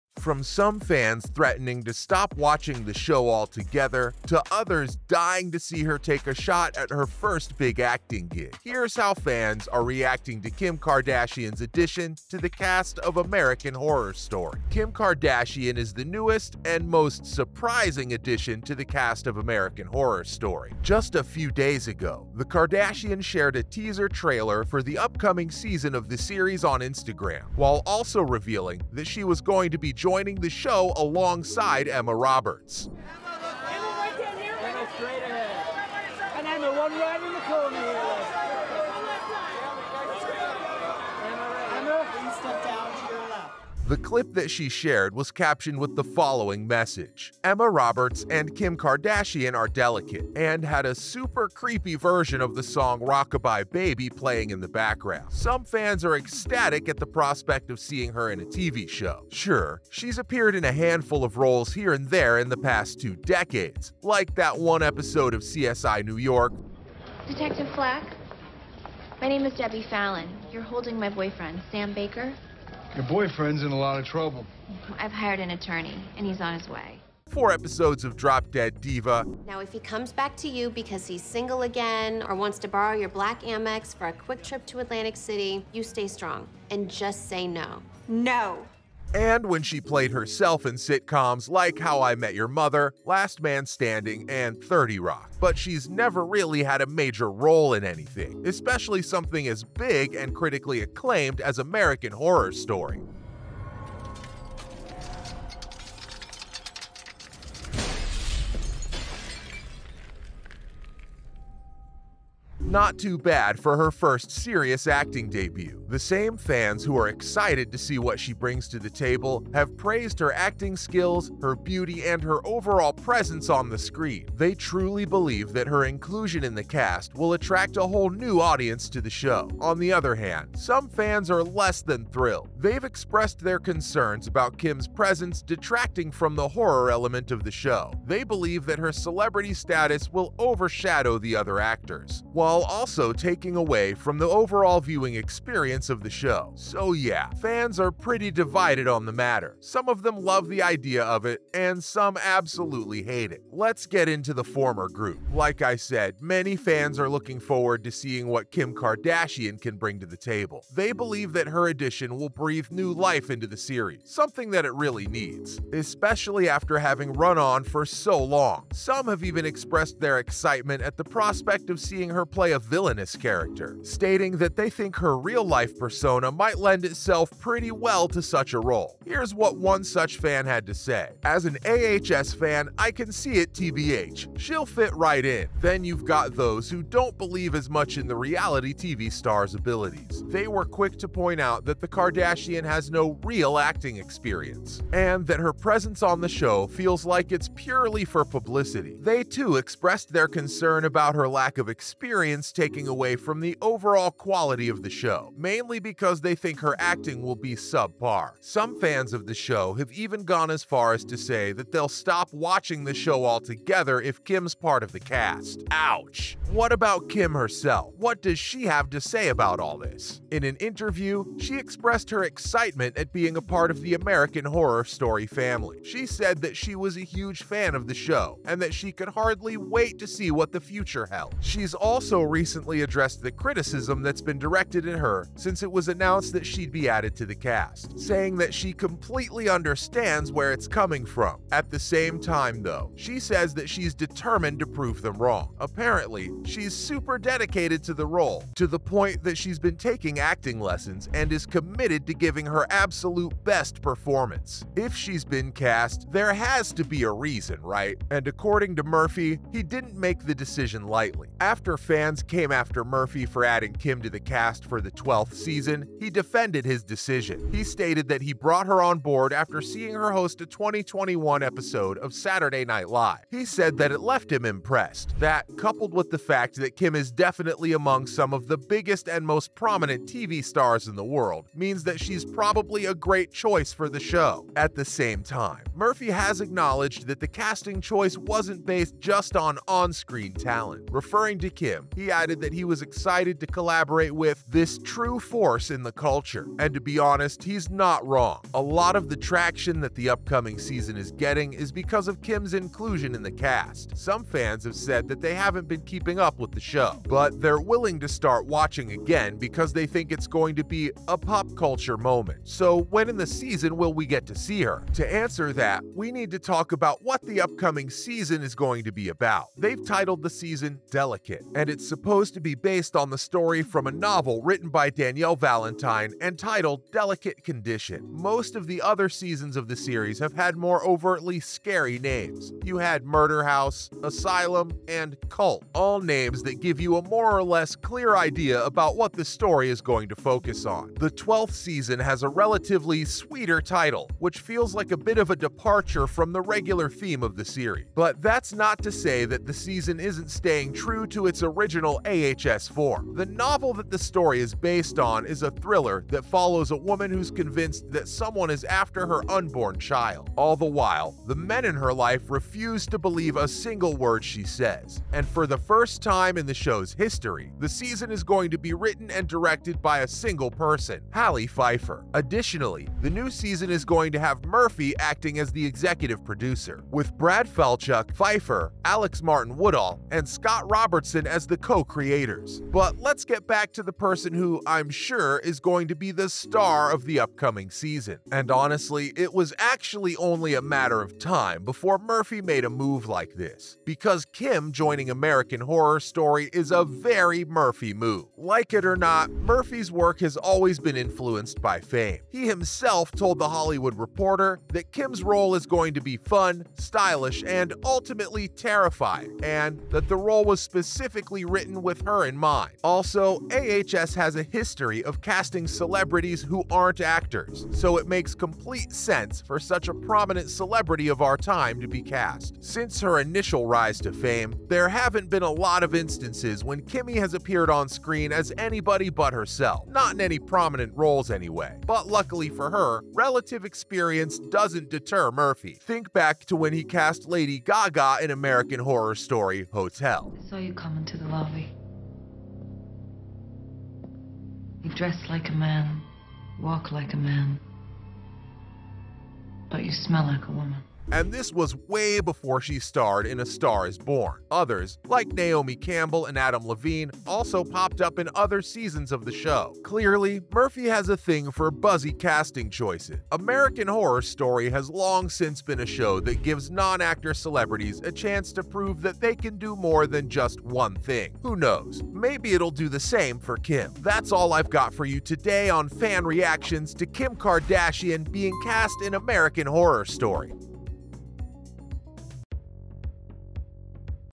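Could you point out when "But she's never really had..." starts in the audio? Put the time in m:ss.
1:35.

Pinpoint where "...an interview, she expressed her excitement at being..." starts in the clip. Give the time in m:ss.
3:40.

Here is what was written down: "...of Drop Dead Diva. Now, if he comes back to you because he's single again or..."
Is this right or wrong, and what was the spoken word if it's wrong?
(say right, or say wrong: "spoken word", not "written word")
right.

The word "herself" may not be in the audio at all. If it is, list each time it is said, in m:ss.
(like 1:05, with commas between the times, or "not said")
1:30, 3:37, 7:09.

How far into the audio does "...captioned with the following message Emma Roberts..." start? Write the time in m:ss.
0:45.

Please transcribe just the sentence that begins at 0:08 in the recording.
Here's how fans are reacting to Kim Kardashian's addition to the cast of American Horror Story.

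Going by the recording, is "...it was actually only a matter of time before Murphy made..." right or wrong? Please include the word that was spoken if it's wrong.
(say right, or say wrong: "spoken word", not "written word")
right.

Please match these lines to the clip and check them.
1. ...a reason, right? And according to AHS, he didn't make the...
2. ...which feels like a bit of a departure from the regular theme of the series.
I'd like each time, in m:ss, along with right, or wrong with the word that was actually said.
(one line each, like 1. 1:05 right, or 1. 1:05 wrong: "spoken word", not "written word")
1. 4:17 wrong: "Murphy", not "AHS"
2. 5:44 right.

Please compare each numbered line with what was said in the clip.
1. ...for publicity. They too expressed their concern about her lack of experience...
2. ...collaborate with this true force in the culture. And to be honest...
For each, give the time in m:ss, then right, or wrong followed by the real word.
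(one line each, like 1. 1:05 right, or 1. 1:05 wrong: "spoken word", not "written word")
1. 3:18 right
2. 4:53 right.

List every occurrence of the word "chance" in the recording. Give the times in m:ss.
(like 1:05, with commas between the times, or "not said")
7:48.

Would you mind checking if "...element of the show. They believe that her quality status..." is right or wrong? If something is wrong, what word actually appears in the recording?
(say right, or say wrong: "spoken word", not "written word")
wrong: "celebrity", not "quality".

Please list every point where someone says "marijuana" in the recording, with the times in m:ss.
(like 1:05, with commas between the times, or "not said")
not said.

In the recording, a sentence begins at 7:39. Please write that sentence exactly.
Clearly, Murphy has a thing for buzzy casting choices.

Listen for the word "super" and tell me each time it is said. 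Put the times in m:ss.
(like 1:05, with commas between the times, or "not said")
0:50, 4:06.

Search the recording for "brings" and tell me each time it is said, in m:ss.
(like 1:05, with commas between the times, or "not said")
1:58, 2:39.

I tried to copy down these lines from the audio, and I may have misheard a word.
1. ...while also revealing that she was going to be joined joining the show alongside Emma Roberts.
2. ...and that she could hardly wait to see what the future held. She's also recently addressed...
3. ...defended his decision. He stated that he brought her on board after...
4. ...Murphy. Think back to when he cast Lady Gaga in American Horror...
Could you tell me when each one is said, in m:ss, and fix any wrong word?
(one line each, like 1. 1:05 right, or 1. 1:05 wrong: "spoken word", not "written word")
1. 0:27 right
2. 3:48 right
3. 4:26 right
4. 7:15 right.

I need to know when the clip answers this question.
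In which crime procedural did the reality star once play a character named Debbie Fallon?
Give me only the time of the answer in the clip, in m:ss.
1:05.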